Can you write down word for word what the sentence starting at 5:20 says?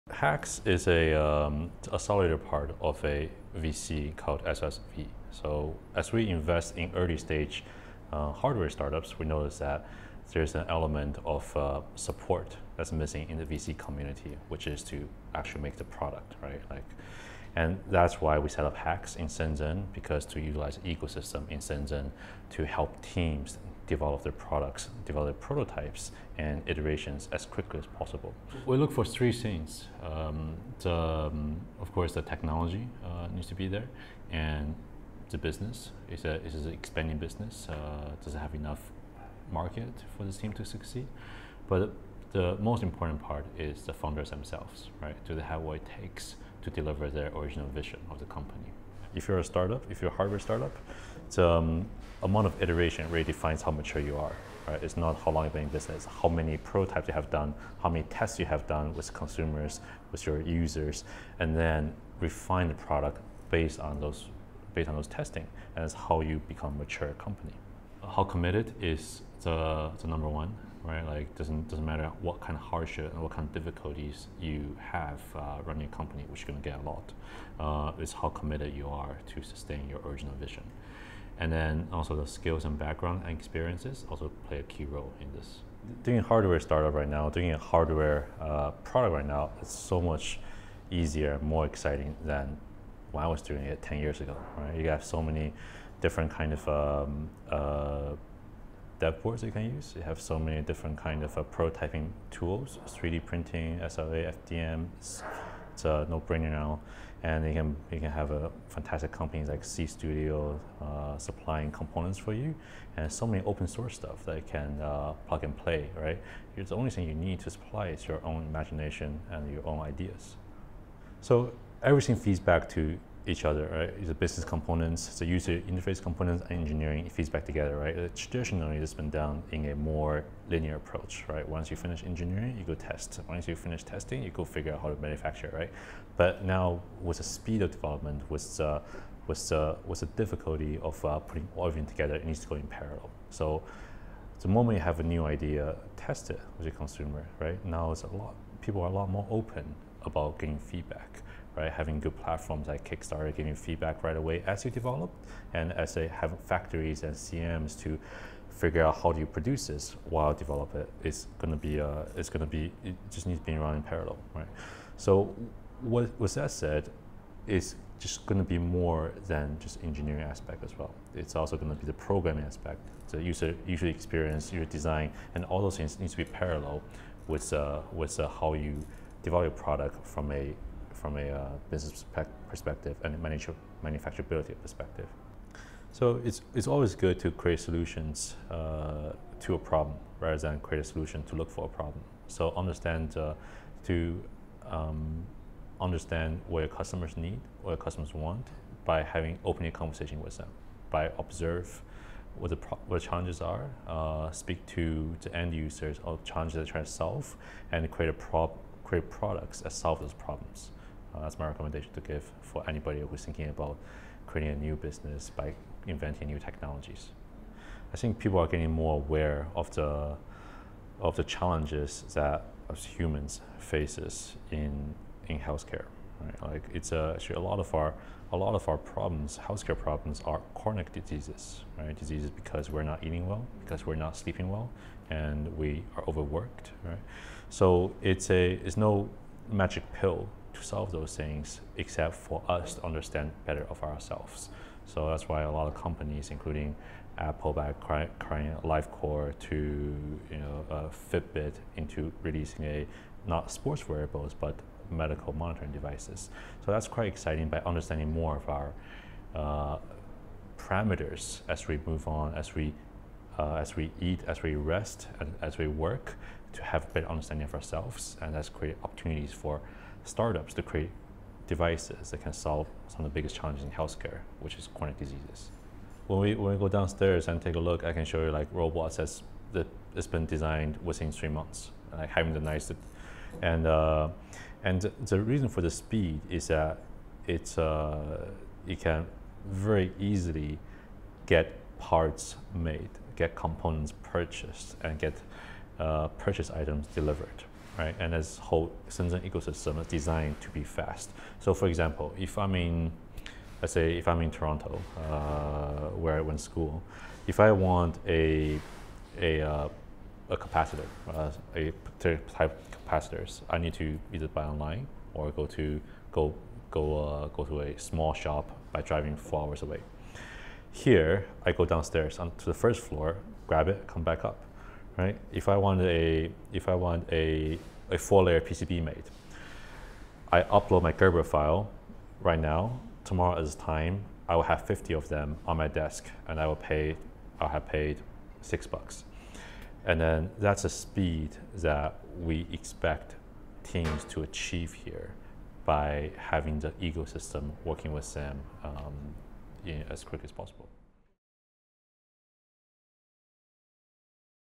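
Here, I go downstairs onto the first floor, grab it, come back up right?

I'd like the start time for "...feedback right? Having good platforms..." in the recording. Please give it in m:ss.
2:30.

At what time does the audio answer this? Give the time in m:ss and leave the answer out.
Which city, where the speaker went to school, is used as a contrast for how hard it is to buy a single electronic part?
5:04.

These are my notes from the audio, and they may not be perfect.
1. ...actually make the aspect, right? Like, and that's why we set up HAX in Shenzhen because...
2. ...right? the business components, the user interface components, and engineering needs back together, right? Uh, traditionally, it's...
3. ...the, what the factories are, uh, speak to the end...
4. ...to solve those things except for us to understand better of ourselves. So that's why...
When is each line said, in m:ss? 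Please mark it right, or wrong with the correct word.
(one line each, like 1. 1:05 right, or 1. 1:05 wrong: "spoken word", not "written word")
1. 0:15 wrong: "product", not "aspect"
2. 2:03 wrong: "feeds", not "needs"
3. 3:22 wrong: "challenges", not "factories"
4. 4:00 right.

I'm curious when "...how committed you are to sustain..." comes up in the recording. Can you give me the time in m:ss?
1:18.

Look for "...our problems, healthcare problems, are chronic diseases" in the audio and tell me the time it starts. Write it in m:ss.
3:48.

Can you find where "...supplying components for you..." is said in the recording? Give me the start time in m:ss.
1:51.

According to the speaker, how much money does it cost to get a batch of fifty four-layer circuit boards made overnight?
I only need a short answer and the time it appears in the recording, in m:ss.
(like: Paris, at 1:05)
6 bucks, at 5:38.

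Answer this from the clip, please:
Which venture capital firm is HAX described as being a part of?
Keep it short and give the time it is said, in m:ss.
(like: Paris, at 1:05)
SSV, at 0:04.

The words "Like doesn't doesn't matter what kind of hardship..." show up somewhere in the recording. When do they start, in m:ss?
1:11.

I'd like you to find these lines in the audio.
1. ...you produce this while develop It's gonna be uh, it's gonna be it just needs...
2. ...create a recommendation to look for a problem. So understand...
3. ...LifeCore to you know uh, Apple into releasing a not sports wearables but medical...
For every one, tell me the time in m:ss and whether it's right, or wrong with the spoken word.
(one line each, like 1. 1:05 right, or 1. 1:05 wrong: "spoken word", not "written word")
1. 2:39 right
2. 3:10 wrong: "solution", not "recommendation"
3. 4:08 wrong: "Fitbit", not "Apple".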